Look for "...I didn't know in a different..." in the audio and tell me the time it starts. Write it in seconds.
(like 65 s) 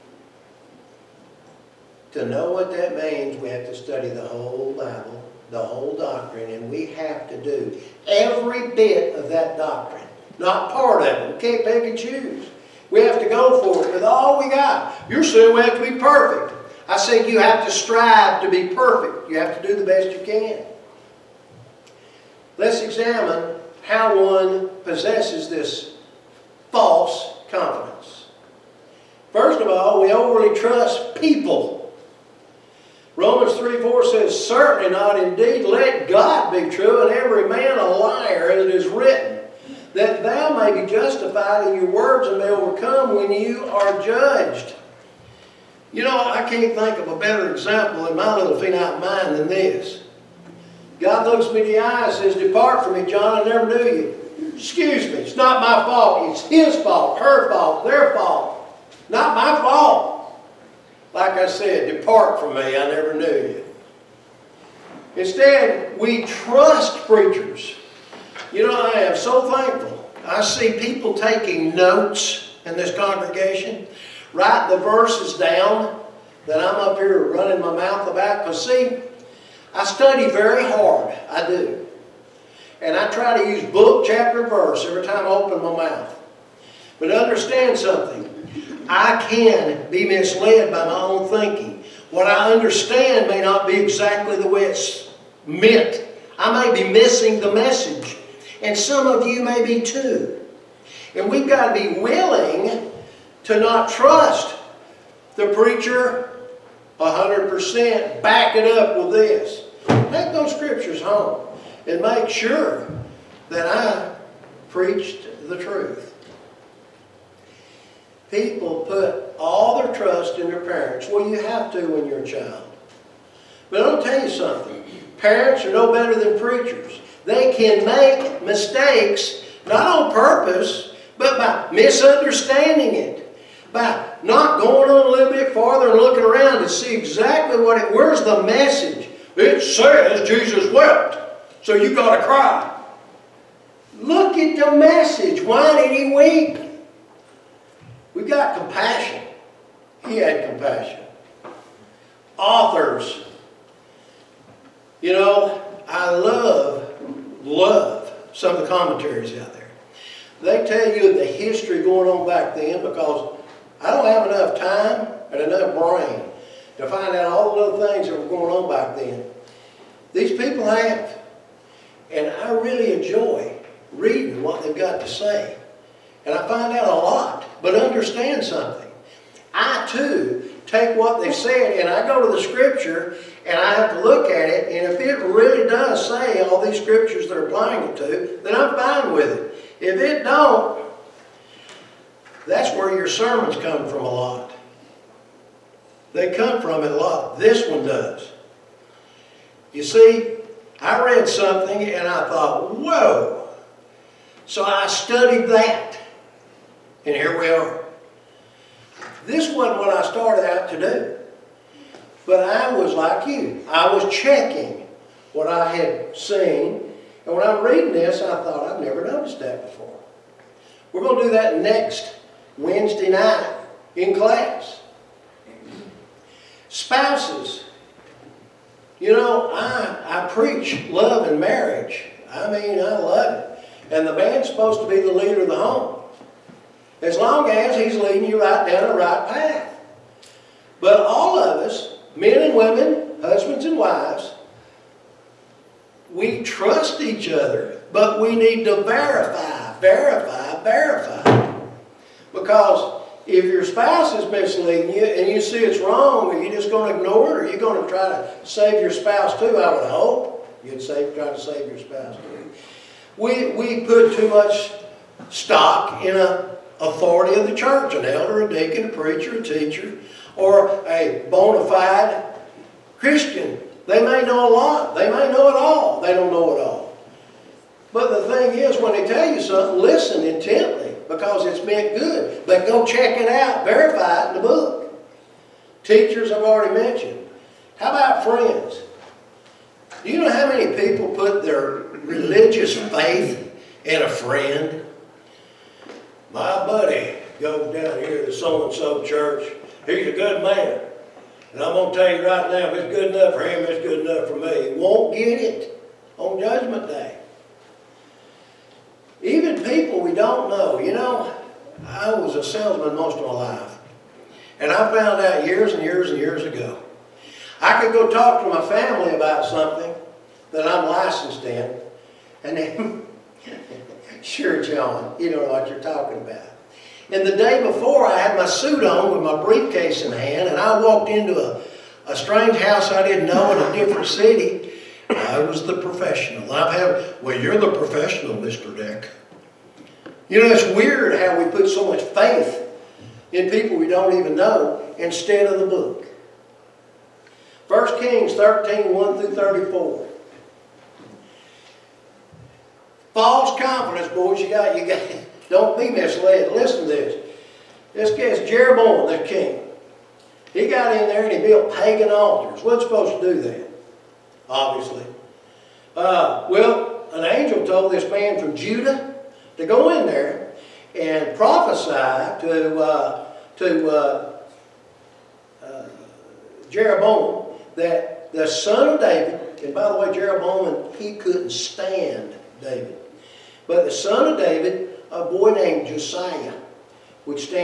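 332 s.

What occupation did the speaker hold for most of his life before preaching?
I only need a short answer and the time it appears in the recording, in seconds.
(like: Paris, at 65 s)
salesman, at 312 s.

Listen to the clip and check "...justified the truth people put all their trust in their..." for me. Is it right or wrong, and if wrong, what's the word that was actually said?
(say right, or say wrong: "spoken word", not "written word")
wrong: "preached", not "justified".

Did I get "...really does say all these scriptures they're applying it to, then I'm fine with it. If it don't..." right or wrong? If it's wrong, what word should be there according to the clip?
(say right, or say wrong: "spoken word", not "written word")
right.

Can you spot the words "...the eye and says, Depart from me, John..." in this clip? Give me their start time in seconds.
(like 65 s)
51 s.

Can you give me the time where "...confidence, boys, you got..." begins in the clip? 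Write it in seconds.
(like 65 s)
353 s.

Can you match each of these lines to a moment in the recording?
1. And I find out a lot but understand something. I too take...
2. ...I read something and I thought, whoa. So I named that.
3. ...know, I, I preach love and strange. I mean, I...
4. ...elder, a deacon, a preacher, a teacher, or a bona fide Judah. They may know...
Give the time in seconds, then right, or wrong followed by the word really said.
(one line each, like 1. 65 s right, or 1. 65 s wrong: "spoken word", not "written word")
1. 176 s right
2. 200 s wrong: "studied", not "named"
3. 229 s wrong: "marriage", not "strange"
4. 268 s wrong: "Christian", not "Judah".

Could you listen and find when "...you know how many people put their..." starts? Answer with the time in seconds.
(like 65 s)
290 s.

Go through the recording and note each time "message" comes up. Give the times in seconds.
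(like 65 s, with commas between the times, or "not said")
97 s, 138 s, 144 s.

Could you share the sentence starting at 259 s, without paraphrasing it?
I would hope you'd save, try to save your spouse too.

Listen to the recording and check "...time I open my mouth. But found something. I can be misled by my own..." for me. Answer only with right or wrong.
wrong.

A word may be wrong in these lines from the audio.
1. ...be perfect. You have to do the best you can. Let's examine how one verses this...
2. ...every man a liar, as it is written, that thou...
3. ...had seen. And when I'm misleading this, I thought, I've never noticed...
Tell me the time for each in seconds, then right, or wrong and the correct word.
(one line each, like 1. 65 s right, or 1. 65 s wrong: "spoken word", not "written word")
1. 18 s wrong: "possesses", not "verses"
2. 37 s right
3. 215 s wrong: "reading", not "misleading".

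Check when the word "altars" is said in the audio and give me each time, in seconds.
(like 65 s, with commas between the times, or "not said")
362 s.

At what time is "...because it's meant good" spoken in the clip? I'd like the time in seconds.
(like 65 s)
281 s.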